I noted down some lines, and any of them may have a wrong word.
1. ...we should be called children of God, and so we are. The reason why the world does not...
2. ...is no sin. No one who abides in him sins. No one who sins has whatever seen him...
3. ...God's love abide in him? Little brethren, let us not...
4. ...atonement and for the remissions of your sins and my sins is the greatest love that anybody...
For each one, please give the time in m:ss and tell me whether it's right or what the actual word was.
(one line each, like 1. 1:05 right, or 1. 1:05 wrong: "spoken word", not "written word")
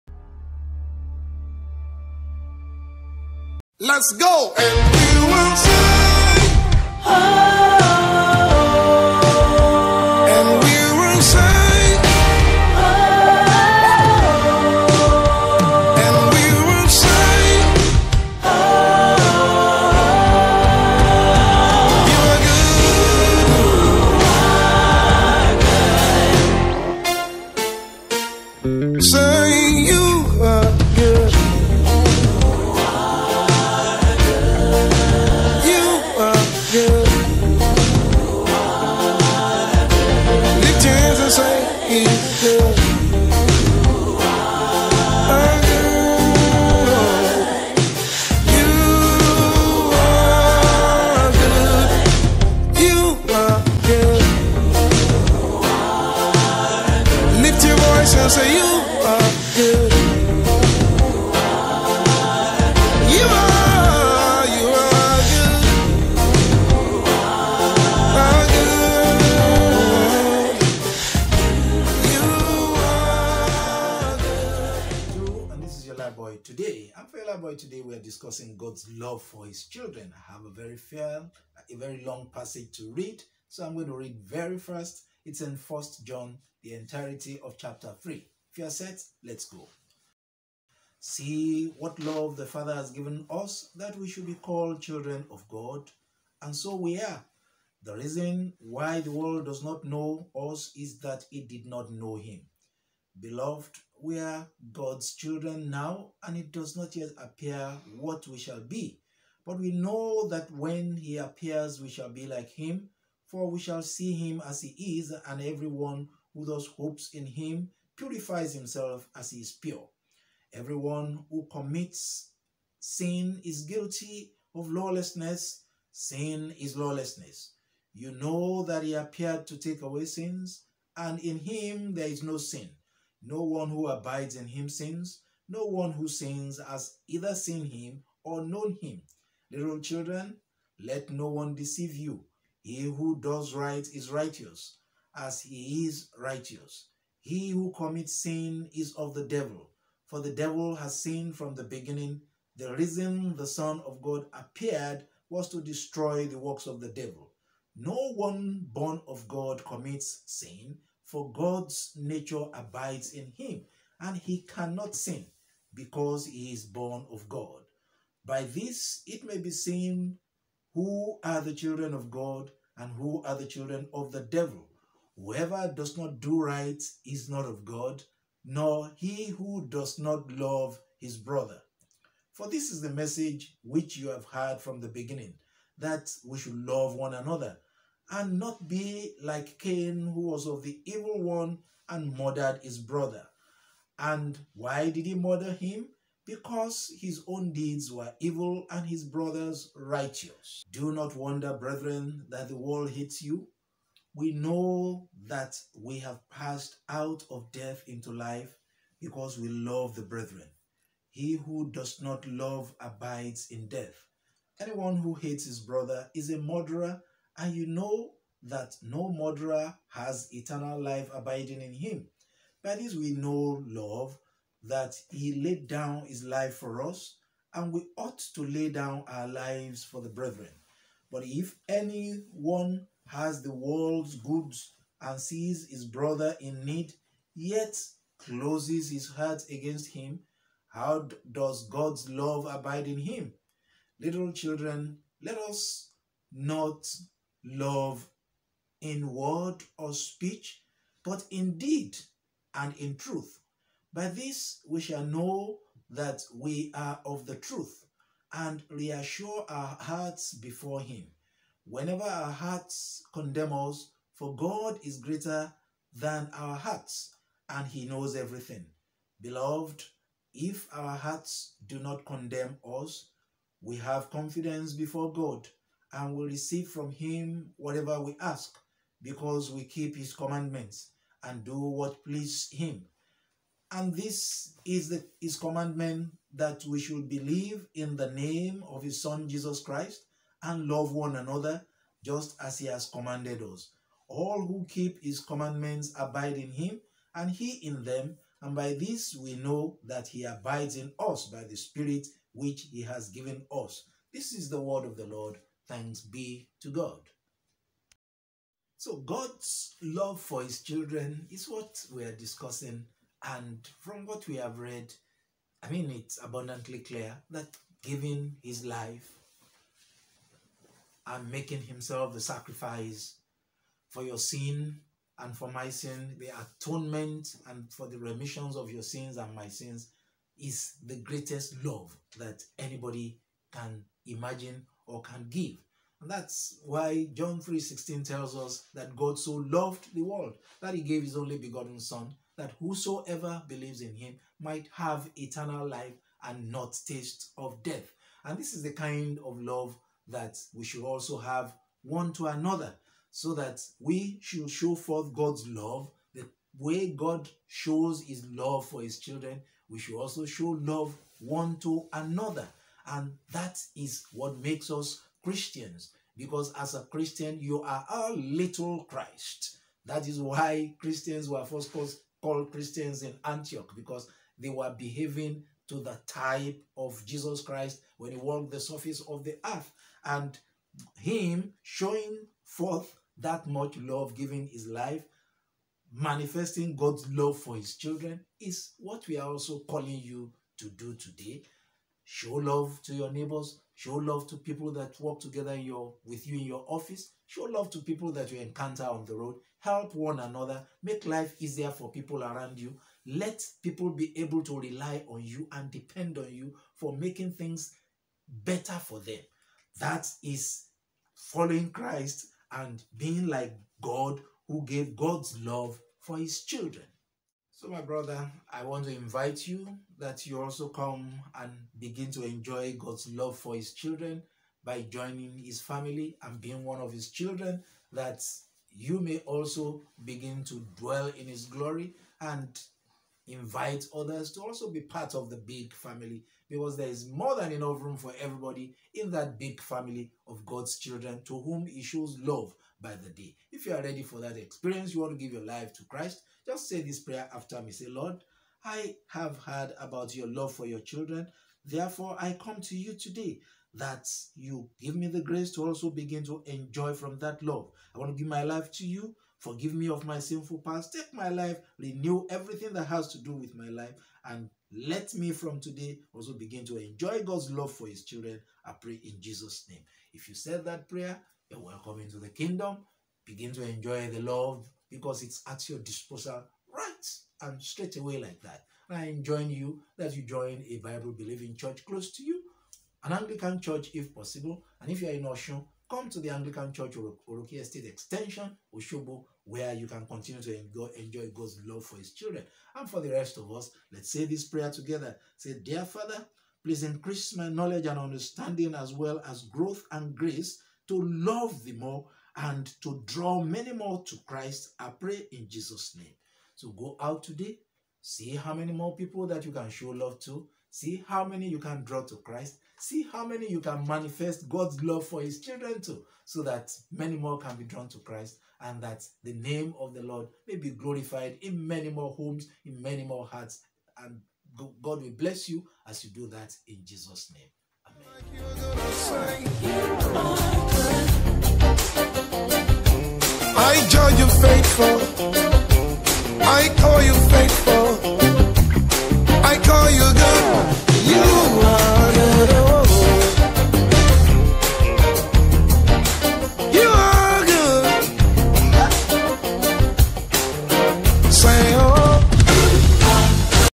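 1. 1:33 right
2. 2:12 wrong: "either", not "whatever"
3. 4:01 wrong: "children", not "brethren"
4. 5:26 right.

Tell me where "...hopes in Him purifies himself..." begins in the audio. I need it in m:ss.
1:56.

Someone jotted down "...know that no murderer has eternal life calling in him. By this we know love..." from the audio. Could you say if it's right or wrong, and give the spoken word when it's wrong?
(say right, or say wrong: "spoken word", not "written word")
wrong: "abiding", not "calling".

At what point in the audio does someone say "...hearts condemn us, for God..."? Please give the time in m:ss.
4:22.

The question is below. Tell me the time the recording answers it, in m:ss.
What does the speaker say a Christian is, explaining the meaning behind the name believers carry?
6:07.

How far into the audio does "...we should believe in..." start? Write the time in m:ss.
4:46.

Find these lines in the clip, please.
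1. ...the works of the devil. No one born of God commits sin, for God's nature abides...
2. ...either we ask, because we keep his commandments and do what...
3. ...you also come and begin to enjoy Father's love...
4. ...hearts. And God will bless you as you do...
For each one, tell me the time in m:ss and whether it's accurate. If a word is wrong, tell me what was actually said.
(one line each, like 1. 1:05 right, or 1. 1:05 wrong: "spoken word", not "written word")
1. 2:36 right
2. 4:37 wrong: "whatever", not "either"
3. 7:00 wrong: "God", not "Father"
4. 8:43 right.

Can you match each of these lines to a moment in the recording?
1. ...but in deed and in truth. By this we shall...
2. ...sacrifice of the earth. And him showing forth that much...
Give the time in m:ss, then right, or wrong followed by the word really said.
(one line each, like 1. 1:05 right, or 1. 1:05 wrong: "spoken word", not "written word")
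1. 4:11 right
2. 6:18 wrong: "surface", not "sacrifice".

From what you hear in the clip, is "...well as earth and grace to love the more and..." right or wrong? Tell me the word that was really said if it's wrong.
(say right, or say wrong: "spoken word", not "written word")
wrong: "growth", not "earth".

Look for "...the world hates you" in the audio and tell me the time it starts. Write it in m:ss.
3:22.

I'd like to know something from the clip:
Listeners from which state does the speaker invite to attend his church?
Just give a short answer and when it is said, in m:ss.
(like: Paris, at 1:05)
Oshun, at 8:05.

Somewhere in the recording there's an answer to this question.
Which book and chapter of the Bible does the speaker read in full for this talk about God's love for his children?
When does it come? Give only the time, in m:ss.
1:25.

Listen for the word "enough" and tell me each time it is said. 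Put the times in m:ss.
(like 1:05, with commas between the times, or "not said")
7:17.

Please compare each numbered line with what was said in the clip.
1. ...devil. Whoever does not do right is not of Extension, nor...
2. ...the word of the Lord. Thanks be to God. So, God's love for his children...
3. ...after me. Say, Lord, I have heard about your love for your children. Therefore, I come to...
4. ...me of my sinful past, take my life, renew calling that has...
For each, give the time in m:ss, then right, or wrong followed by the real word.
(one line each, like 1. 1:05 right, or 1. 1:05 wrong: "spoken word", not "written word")
1. 2:54 wrong: "God", not "Extension"
2. 5:04 right
3. 7:27 right
4. 7:39 wrong: "everything", not "calling".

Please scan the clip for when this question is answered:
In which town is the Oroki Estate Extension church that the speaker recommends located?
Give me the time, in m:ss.
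8:08.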